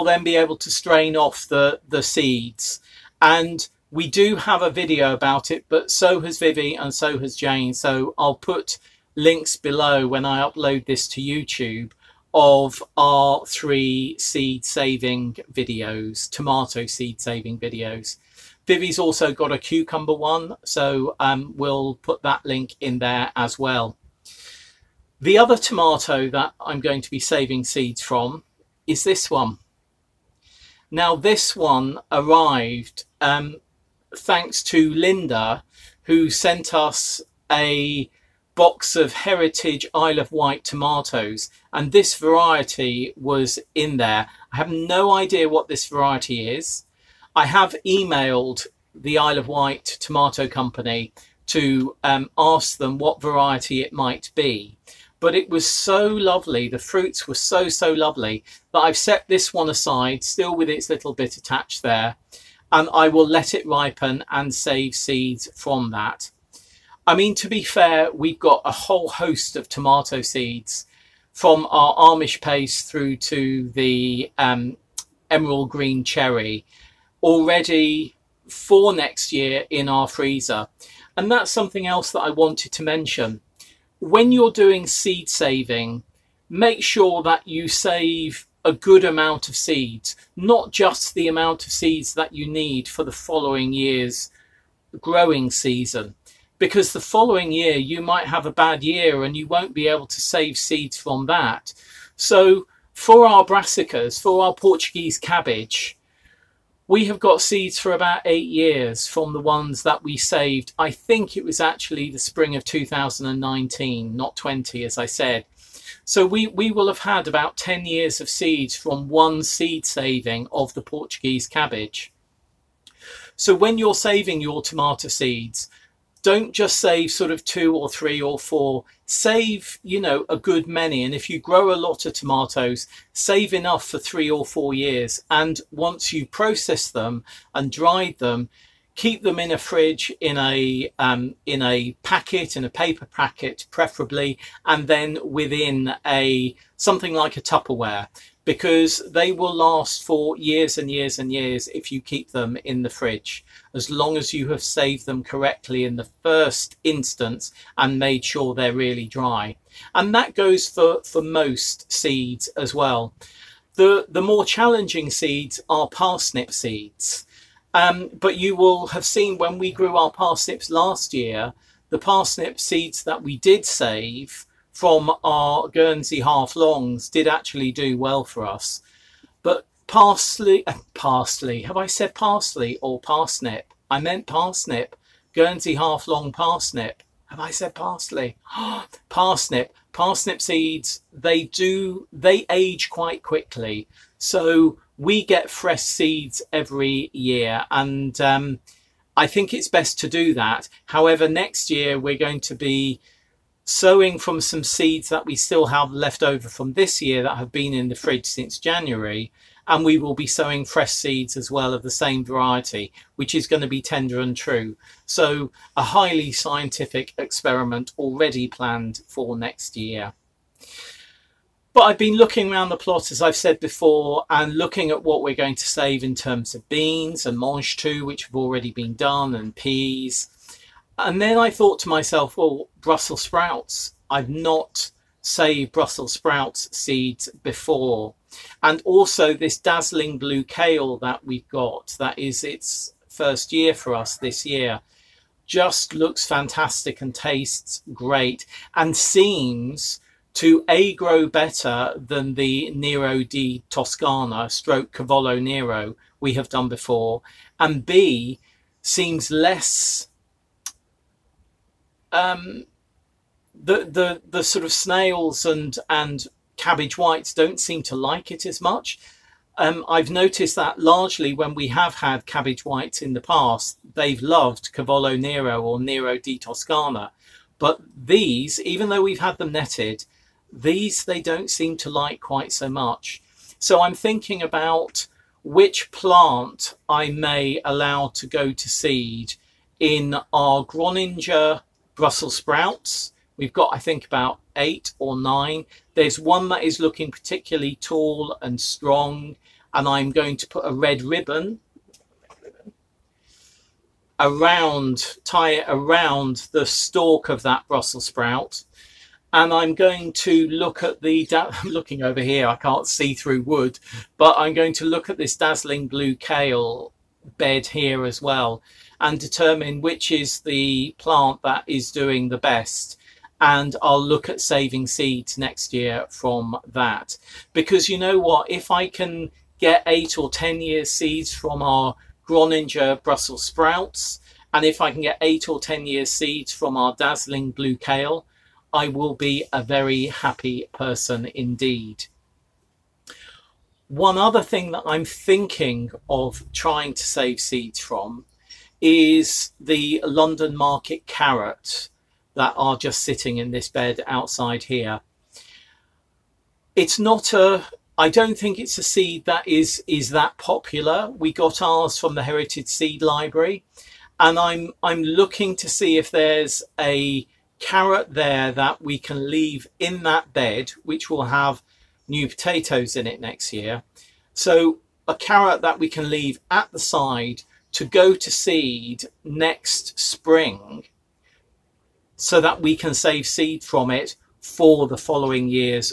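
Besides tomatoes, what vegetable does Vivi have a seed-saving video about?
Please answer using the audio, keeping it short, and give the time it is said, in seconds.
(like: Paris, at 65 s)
Cucumber, at 19 s.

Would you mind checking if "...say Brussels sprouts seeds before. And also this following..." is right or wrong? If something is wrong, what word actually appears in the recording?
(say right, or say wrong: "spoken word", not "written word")
wrong: "dazzling", not "following".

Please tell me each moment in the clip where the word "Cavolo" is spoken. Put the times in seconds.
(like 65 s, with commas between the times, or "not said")
254 s, 274 s.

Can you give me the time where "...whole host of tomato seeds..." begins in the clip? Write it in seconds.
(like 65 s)
68 s.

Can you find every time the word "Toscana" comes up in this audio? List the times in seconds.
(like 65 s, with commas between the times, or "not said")
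253 s, 276 s.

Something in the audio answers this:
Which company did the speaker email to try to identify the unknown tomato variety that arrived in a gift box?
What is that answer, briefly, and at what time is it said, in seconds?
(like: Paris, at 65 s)
Isle of Wight Tomato Company, at 49 s.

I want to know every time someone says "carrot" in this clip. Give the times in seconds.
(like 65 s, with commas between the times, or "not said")
351 s, 367 s, 375 s.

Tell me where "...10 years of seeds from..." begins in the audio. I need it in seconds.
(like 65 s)
117 s.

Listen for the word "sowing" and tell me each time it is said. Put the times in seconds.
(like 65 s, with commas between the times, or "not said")
203 s, 210 s.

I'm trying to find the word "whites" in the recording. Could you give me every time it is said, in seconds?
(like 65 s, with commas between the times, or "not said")
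266 s, 272 s.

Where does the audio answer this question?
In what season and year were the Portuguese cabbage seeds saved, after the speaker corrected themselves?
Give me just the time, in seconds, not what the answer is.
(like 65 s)
112 s.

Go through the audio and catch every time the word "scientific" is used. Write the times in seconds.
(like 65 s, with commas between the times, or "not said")
216 s.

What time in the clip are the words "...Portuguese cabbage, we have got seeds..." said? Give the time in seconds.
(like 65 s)
104 s.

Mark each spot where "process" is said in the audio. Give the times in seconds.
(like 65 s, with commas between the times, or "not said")
136 s.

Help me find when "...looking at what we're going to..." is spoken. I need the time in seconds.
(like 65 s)
224 s.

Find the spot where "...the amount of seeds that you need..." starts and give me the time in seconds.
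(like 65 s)
91 s.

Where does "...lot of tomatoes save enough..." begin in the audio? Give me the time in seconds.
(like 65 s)
131 s.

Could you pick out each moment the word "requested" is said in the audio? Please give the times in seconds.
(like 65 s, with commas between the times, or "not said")
not said.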